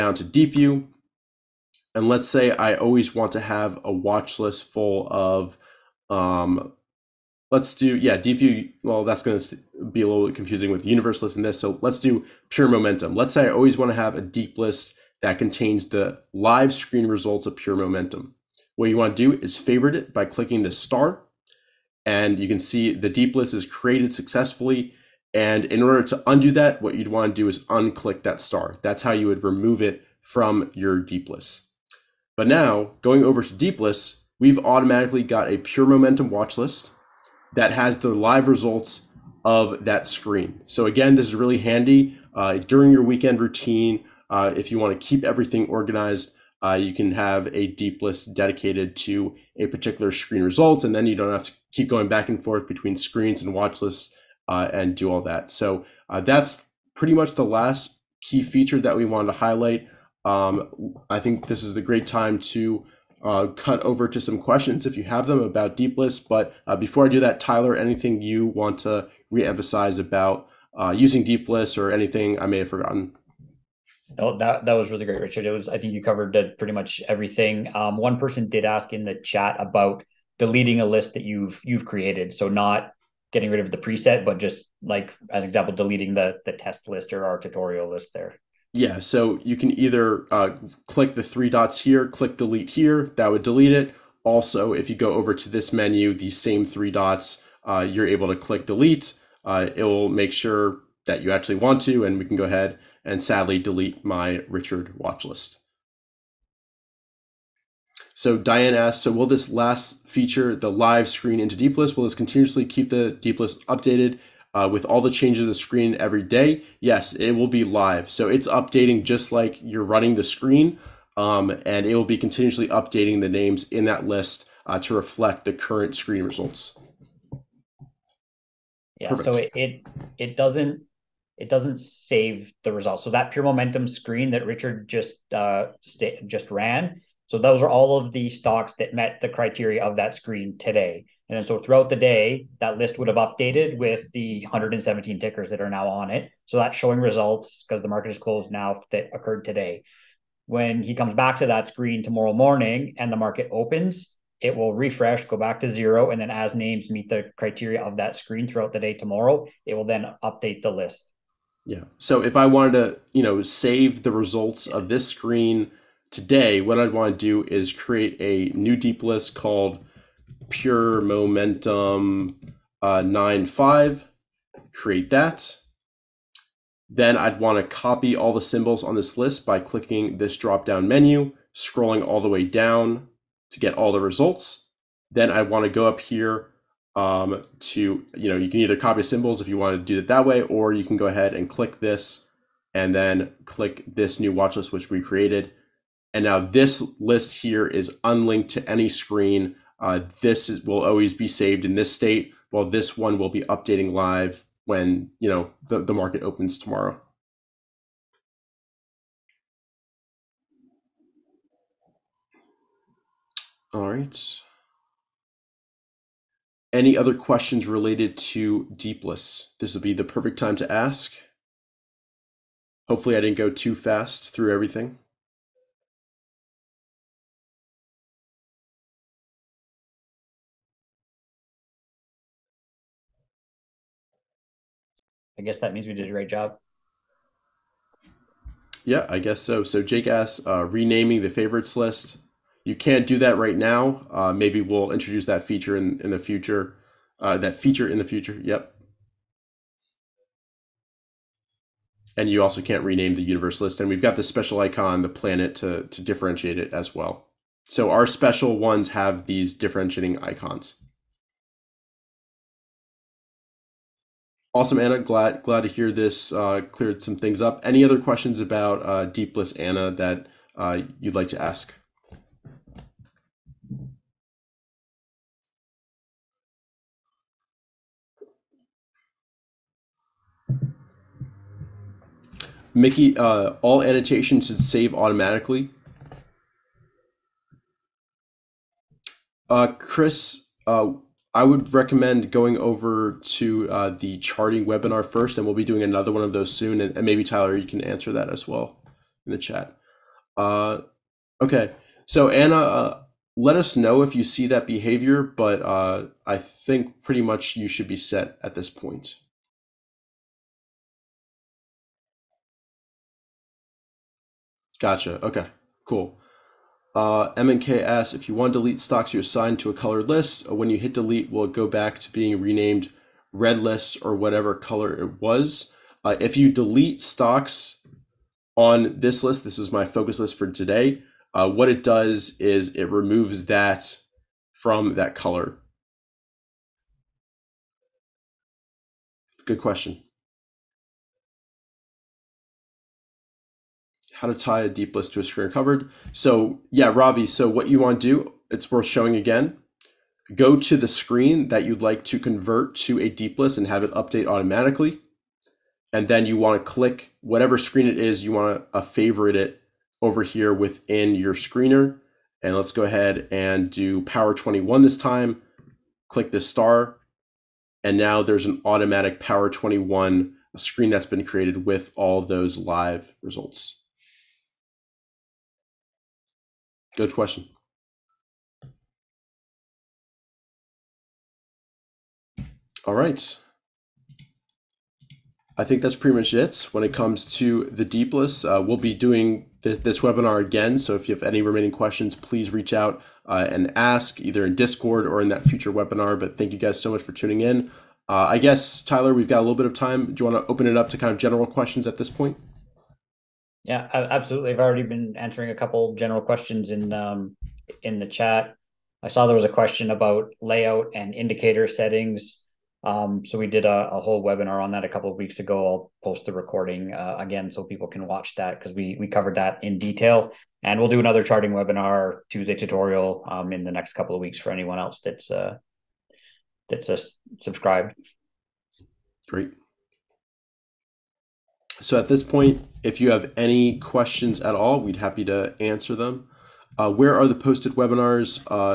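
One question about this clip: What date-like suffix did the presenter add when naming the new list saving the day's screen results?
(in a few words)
9 5.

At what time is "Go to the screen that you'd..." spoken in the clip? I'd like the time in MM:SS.
05:50.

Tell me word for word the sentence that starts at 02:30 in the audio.
When he comes back to that screen tomorrow morning and the market opens, it will refresh, go back to zero.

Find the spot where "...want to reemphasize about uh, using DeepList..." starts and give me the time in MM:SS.
01:08.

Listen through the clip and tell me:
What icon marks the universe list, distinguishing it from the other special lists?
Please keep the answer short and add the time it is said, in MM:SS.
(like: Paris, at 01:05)
The planet, at 04:14.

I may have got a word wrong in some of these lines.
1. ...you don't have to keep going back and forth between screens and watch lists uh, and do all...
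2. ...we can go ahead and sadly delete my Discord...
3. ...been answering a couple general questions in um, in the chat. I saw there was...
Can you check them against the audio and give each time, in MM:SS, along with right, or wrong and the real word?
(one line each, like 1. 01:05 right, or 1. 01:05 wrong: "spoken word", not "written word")
1. 00:51 right
2. 01:42 wrong: "Richard", not "Discord"
3. 06:44 right.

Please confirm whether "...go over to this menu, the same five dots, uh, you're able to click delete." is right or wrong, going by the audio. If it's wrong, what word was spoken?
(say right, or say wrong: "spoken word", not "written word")
wrong: "three", not "five".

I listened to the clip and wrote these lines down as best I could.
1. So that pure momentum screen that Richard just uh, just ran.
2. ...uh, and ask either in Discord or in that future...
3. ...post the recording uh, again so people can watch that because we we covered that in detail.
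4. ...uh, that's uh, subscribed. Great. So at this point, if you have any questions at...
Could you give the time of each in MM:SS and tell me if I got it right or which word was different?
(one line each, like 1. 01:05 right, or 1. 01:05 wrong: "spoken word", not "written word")
1. 02:13 right
2. 06:33 right
3. 06:56 right
4. 07:05 right.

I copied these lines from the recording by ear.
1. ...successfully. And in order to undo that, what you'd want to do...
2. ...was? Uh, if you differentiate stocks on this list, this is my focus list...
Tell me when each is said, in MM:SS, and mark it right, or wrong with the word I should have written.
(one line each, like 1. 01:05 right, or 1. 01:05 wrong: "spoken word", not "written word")
1. 00:24 right
2. 05:25 wrong: "delete", not "differentiate".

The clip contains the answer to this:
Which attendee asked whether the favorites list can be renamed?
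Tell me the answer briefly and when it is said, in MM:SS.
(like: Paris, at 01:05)
Jake, at 03:59.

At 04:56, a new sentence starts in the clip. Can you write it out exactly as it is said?
And, and maybe Tyler, you can answer that as well in the chat.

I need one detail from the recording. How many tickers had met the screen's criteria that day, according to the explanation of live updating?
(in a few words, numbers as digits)
117.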